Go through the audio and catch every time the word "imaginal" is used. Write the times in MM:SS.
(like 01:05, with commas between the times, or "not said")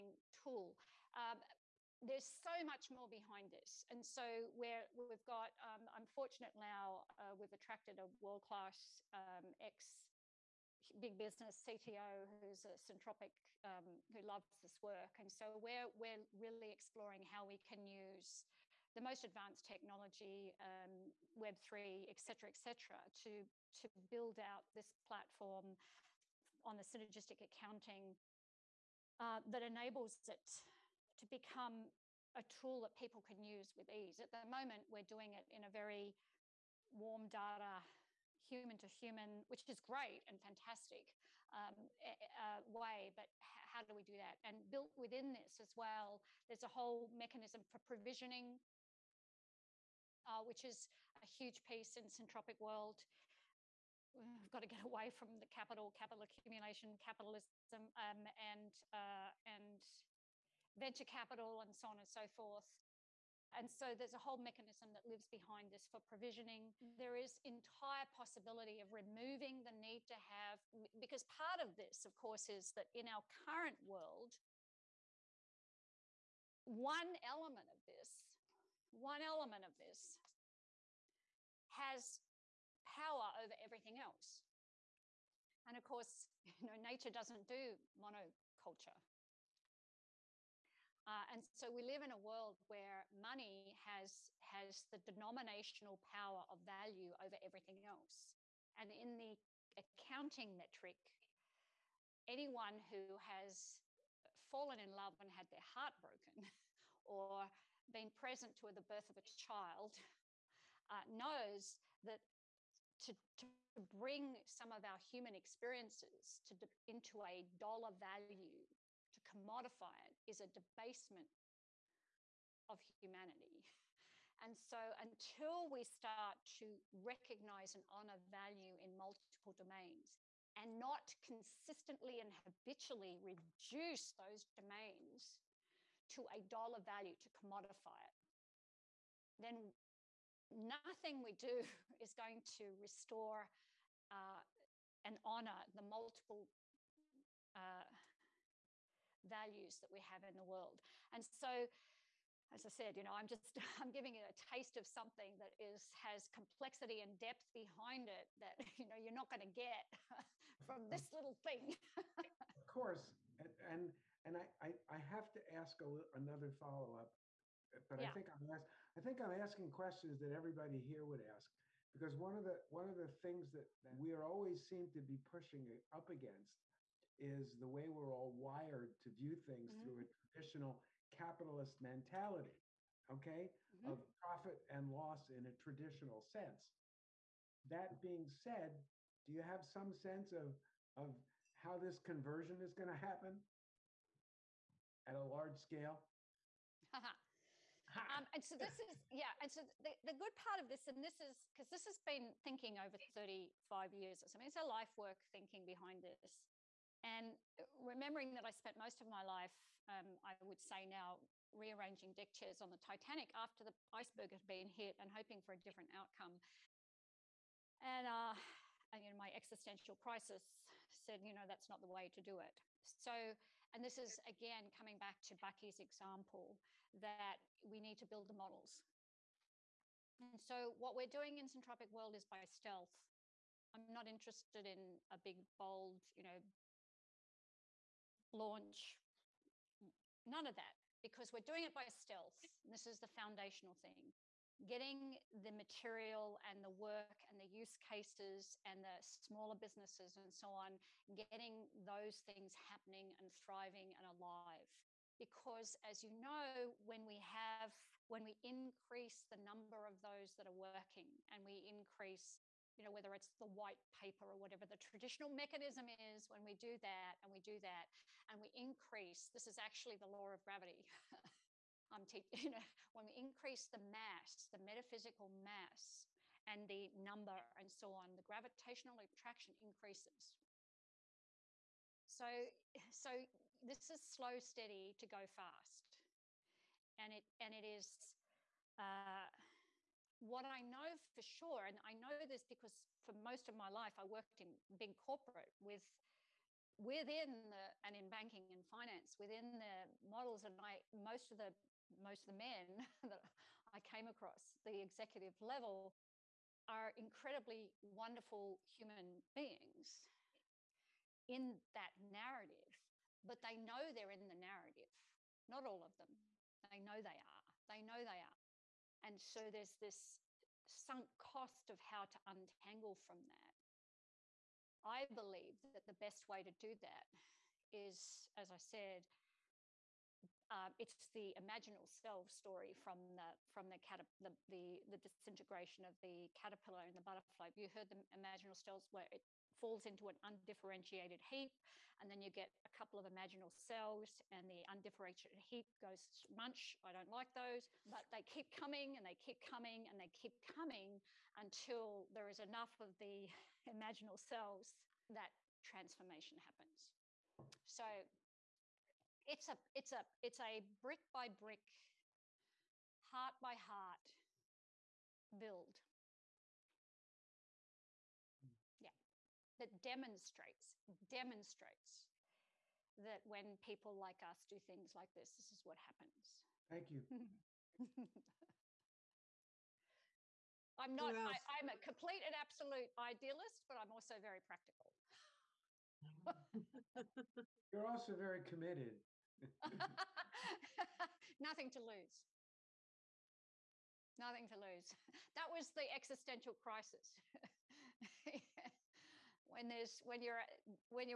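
05:31, 05:38, 05:43, 05:53.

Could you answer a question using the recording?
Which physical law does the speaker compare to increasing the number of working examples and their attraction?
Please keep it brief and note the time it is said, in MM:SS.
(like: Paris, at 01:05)
law of gravity, at 04:30.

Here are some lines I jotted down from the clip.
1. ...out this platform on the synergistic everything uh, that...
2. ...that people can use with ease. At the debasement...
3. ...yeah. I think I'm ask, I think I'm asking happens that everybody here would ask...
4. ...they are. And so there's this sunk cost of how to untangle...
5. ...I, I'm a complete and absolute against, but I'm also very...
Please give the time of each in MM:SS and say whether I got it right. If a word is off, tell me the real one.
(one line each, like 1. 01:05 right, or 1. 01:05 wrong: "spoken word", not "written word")
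1. 00:24 wrong: "accounting", not "everything"
2. 00:32 wrong: "moment", not "debasement"
3. 02:47 wrong: "questions", not "happens"
4. 05:18 right
5. 06:21 wrong: "idealist", not "against".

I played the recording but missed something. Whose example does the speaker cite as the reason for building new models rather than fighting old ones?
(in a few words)
Bucky.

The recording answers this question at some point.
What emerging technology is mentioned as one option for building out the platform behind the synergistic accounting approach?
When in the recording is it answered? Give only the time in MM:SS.
00:21.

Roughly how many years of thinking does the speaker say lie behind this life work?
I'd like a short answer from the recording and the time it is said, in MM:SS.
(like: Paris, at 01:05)
35 years, at 03:23.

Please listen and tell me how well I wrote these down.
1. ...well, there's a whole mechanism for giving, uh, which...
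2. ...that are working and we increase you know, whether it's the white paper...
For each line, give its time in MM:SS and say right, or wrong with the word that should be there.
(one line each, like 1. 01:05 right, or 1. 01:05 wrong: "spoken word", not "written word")
1. 00:45 wrong: "provisioning", not "giving"
2. 04:20 right.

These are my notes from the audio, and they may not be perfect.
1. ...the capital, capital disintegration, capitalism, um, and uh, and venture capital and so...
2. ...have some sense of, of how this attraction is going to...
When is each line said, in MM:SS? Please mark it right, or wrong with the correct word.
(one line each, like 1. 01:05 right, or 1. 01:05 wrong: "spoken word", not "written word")
1. 00:55 wrong: "accumulation", not "disintegration"
2. 03:09 wrong: "conversion", not "attraction".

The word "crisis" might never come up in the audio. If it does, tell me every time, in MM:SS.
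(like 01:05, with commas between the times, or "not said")
03:39, 06:36.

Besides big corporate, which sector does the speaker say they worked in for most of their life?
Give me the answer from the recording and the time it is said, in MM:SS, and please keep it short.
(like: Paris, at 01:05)
banking and finance, at 04:58.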